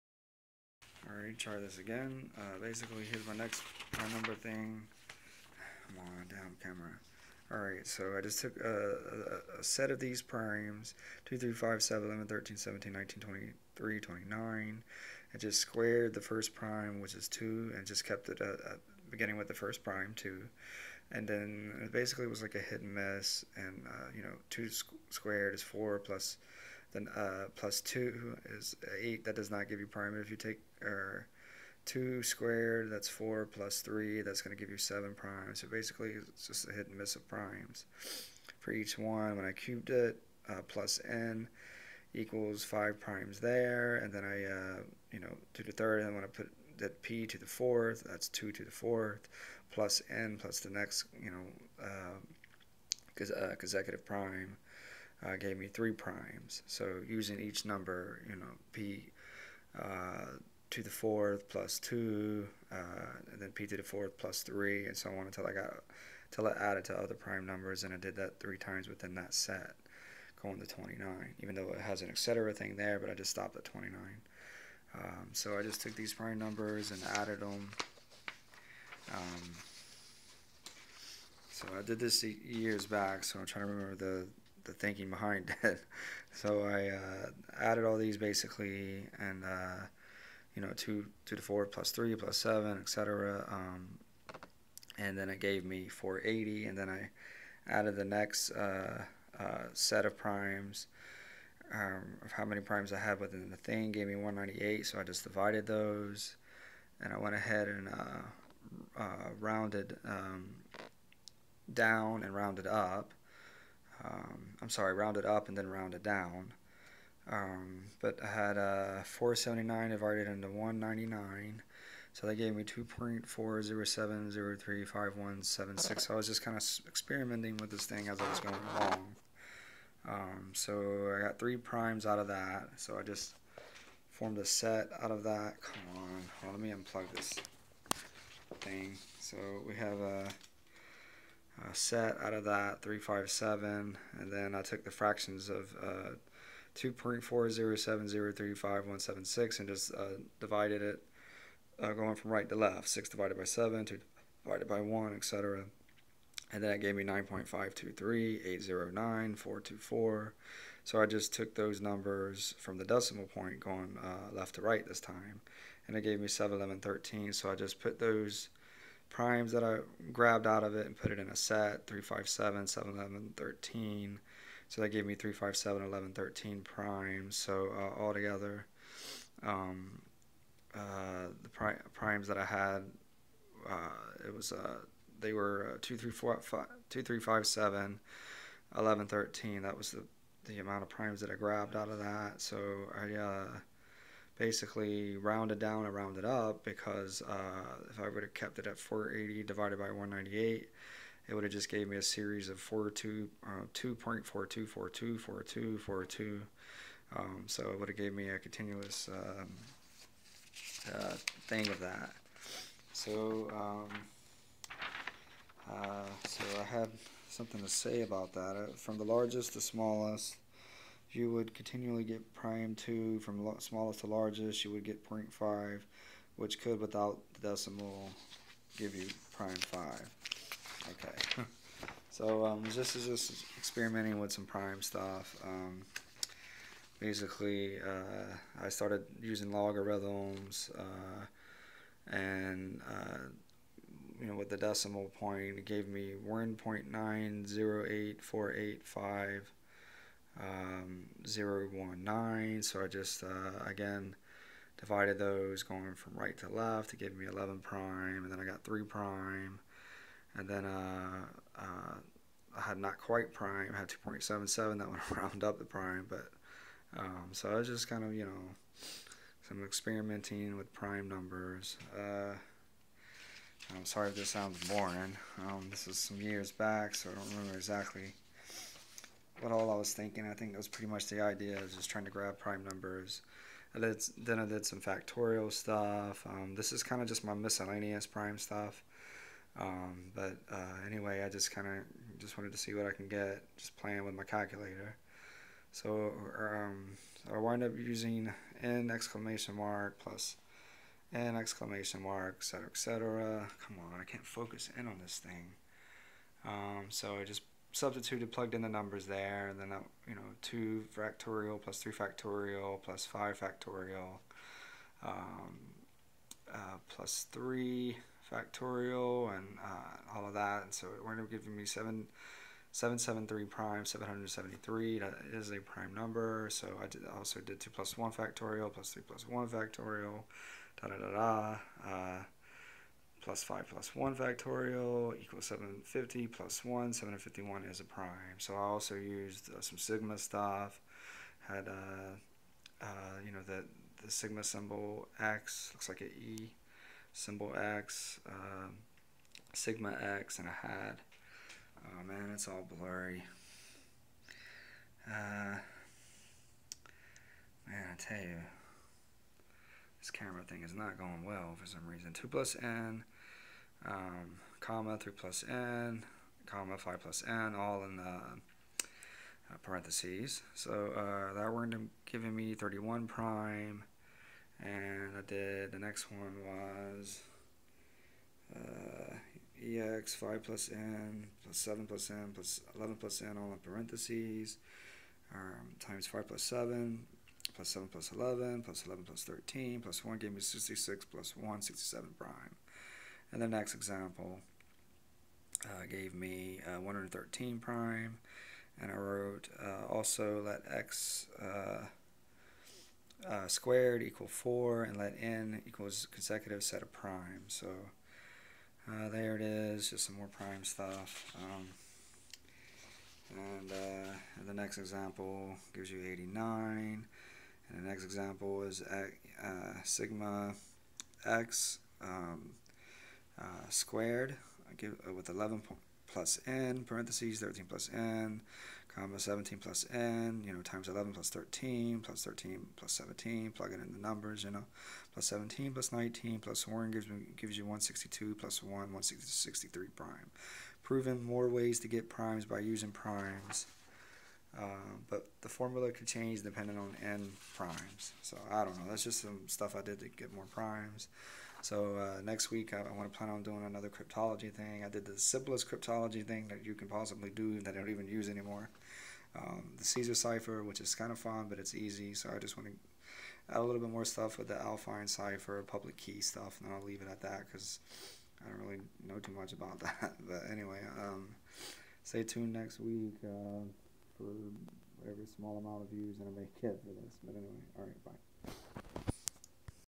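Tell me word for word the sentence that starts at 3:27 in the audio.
Um, so it would have gave me a continuous um, uh, thing of that.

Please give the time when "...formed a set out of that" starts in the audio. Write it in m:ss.
2:14.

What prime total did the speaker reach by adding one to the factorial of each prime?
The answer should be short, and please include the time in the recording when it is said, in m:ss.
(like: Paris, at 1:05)
751, at 5:36.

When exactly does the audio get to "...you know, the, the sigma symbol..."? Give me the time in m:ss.
5:43.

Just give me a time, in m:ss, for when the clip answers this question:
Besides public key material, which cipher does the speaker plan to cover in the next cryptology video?
7:44.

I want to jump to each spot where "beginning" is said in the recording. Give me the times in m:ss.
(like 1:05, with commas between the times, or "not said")
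0:19.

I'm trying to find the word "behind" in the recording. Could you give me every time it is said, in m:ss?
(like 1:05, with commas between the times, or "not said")
1:25.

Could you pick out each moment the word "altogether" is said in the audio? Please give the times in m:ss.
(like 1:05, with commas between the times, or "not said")
2:58.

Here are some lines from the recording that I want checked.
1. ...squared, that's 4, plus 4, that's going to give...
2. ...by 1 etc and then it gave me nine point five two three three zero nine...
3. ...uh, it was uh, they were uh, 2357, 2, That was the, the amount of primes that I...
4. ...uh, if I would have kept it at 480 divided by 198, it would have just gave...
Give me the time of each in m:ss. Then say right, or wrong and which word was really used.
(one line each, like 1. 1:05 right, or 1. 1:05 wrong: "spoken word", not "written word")
1. 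0:32 wrong: "3", not "4"
2. 2:34 wrong: "eight", not "three"
3. 3:03 right
4. 3:17 right.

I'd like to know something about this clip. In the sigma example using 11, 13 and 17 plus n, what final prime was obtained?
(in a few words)
163.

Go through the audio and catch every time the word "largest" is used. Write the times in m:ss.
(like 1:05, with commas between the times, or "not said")
3:39, 3:44.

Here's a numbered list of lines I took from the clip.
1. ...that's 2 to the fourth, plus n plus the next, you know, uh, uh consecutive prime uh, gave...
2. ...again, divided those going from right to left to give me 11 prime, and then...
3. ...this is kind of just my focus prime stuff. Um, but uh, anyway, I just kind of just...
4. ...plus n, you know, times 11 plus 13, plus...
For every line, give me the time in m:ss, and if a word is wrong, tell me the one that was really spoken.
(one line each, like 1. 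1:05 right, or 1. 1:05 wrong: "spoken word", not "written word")
1. 0:48 right
2. 4:13 right
3. 4:46 wrong: "miscellaneous", not "focus"
4. 7:09 right.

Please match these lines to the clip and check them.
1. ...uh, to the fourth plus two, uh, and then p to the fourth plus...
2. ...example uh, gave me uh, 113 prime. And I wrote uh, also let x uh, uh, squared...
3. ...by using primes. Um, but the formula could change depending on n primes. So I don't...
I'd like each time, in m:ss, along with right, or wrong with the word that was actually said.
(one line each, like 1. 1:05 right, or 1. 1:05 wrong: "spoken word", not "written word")
1. 0:59 right
2. 6:33 right
3. 7:22 right.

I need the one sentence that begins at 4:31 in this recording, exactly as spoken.
Uh, I'm sorry if this sounds boring.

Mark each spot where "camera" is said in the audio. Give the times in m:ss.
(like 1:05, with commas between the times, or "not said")
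0:06, 6:00.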